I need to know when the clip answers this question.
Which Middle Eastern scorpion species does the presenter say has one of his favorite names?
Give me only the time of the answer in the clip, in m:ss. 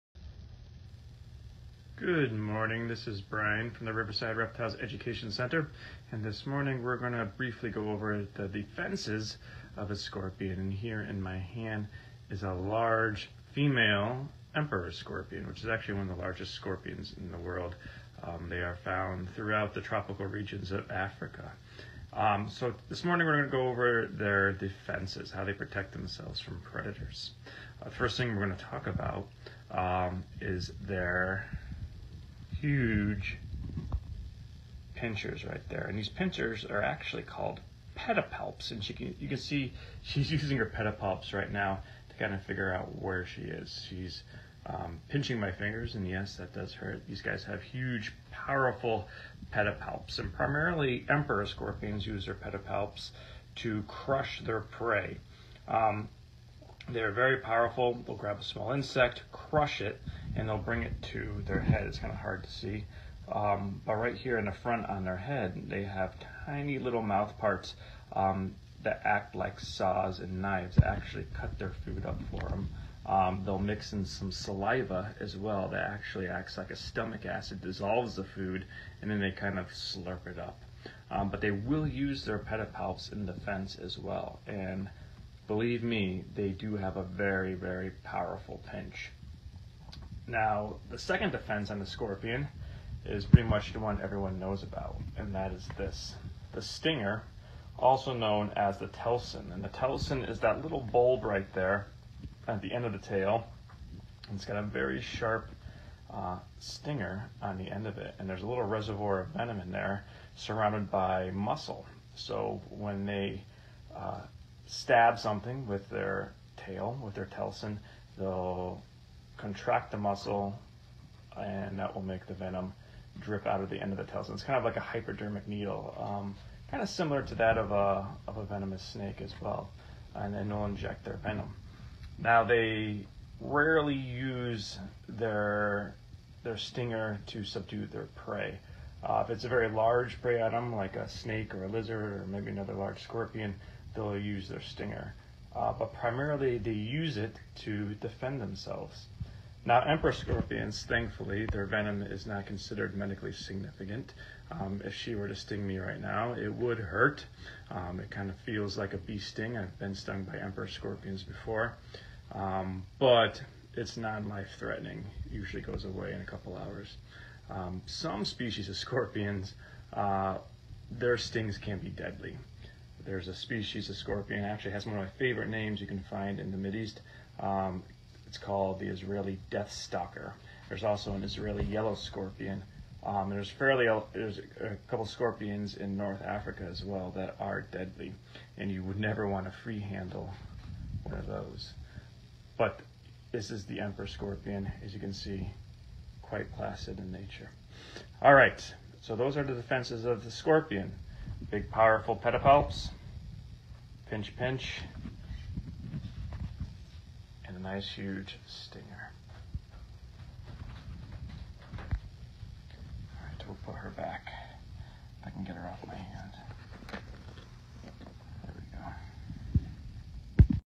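2:58.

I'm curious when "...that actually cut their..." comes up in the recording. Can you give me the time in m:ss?
1:10.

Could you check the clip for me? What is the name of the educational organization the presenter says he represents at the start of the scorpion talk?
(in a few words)
Riverside Reptiles Education Center.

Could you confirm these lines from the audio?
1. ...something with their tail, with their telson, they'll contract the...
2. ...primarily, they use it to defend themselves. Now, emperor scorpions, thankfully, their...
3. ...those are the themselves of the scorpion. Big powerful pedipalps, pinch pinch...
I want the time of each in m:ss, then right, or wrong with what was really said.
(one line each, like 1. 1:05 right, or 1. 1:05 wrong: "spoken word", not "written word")
1. 1:55 right
2. 2:25 right
3. 3:19 wrong: "defenses", not "themselves".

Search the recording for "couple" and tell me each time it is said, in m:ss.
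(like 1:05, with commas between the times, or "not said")
2:46, 3:04.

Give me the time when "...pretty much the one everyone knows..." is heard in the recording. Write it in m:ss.
1:33.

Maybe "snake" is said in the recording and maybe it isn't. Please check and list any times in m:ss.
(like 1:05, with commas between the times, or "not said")
2:08, 2:21.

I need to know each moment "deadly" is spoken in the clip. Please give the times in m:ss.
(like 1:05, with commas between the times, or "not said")
2:51, 3:07.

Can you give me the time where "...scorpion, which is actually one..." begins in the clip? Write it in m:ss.
0:14.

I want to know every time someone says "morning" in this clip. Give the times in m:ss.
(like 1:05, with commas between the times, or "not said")
0:02, 0:06, 0:23.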